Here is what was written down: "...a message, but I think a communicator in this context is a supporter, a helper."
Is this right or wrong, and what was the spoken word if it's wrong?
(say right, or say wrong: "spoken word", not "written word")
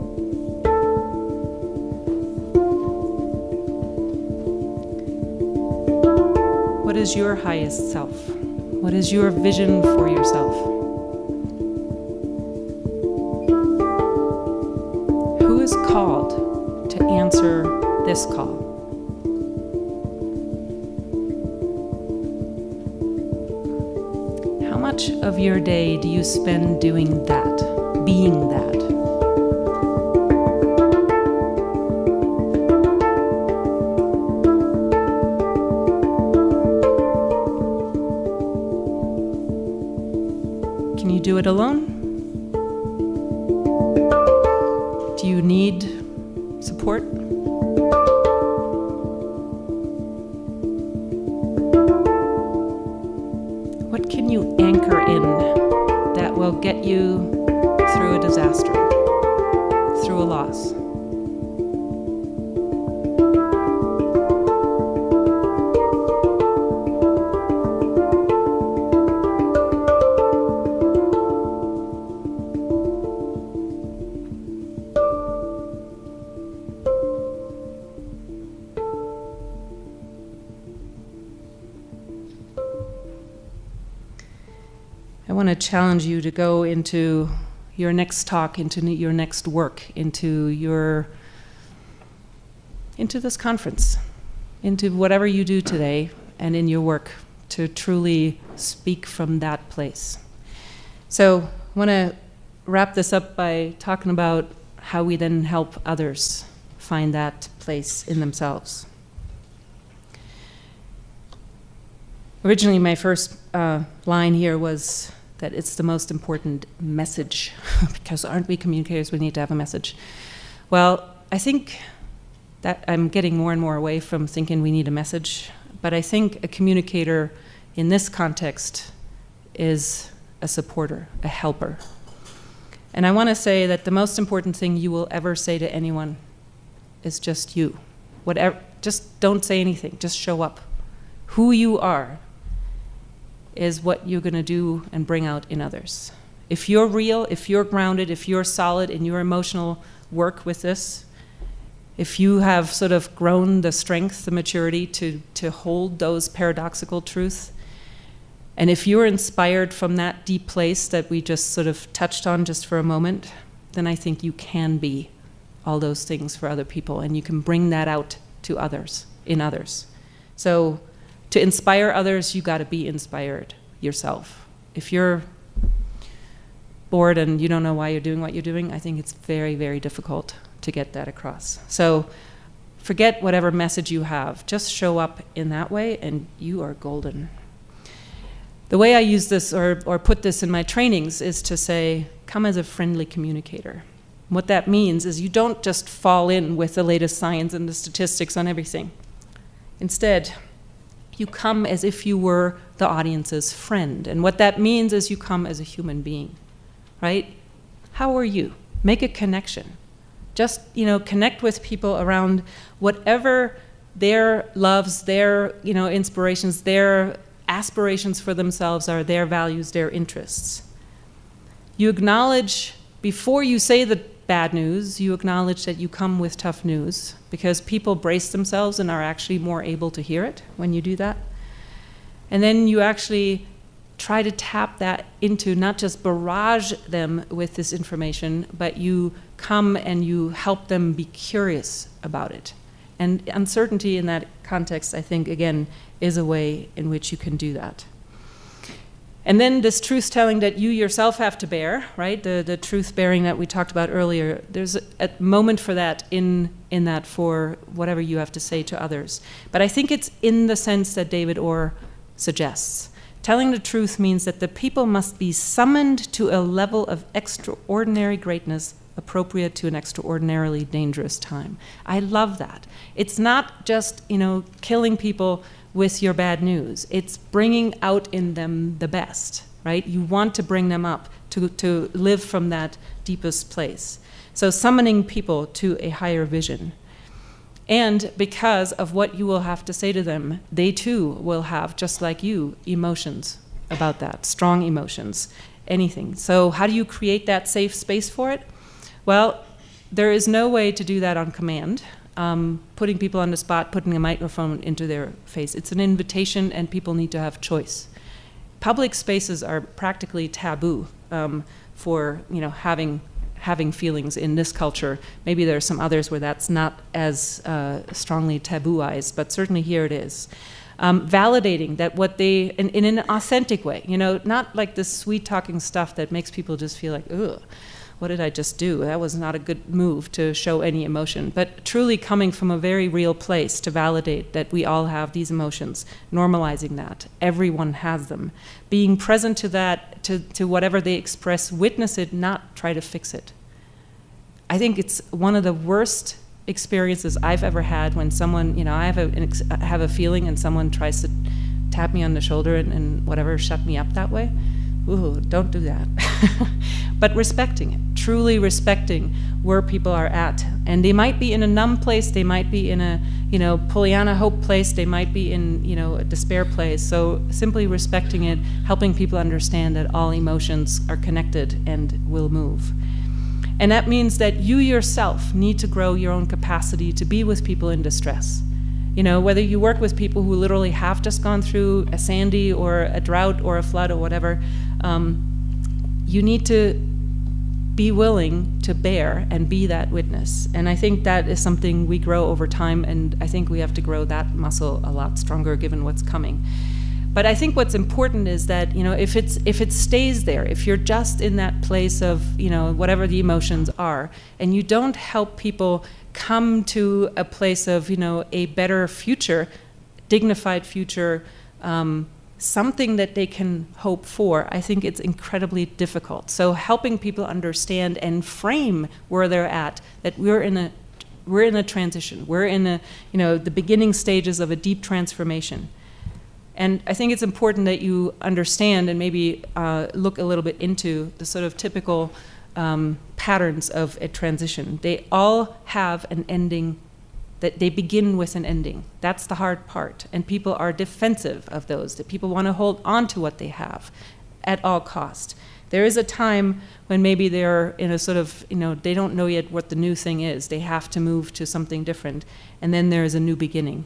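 right.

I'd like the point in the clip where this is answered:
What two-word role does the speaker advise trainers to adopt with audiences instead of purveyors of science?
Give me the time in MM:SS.
03:12.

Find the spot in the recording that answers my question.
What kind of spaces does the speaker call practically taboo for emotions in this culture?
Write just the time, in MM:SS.
05:08.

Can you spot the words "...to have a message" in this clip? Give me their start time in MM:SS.
01:59.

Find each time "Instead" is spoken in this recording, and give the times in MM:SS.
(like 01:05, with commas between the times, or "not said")
03:19.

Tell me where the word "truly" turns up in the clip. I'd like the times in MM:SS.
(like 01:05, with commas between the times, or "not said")
01:37, 05:31, 05:57.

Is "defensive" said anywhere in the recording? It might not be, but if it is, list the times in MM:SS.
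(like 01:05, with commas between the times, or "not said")
07:20.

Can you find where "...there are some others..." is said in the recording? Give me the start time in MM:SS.
05:15.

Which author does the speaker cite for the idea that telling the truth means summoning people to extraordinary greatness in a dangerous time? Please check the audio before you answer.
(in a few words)
David Orr.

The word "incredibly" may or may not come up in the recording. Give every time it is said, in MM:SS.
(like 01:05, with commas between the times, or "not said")
06:55.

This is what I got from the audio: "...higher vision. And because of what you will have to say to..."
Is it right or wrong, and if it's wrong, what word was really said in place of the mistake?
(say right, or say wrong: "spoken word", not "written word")
right.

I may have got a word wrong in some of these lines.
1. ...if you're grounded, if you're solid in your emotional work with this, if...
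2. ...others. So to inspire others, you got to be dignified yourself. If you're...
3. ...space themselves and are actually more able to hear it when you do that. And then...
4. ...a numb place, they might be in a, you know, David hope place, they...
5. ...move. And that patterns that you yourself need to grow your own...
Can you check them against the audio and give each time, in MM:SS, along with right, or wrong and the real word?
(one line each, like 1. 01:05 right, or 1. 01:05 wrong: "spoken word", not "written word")
1. 02:27 right
2. 02:49 wrong: "inspired", not "dignified"
3. 03:47 wrong: "brace", not "space"
4. 06:01 wrong: "Pollyanna", not "David"
5. 06:12 wrong: "means", not "patterns".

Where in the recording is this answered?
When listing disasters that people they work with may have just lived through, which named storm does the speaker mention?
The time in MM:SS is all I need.
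06:21.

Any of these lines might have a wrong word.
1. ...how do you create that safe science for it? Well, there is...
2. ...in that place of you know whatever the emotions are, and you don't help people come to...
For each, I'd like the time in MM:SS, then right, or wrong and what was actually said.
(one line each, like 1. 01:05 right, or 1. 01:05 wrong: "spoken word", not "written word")
1. 04:56 wrong: "space", not "science"
2. 06:41 right.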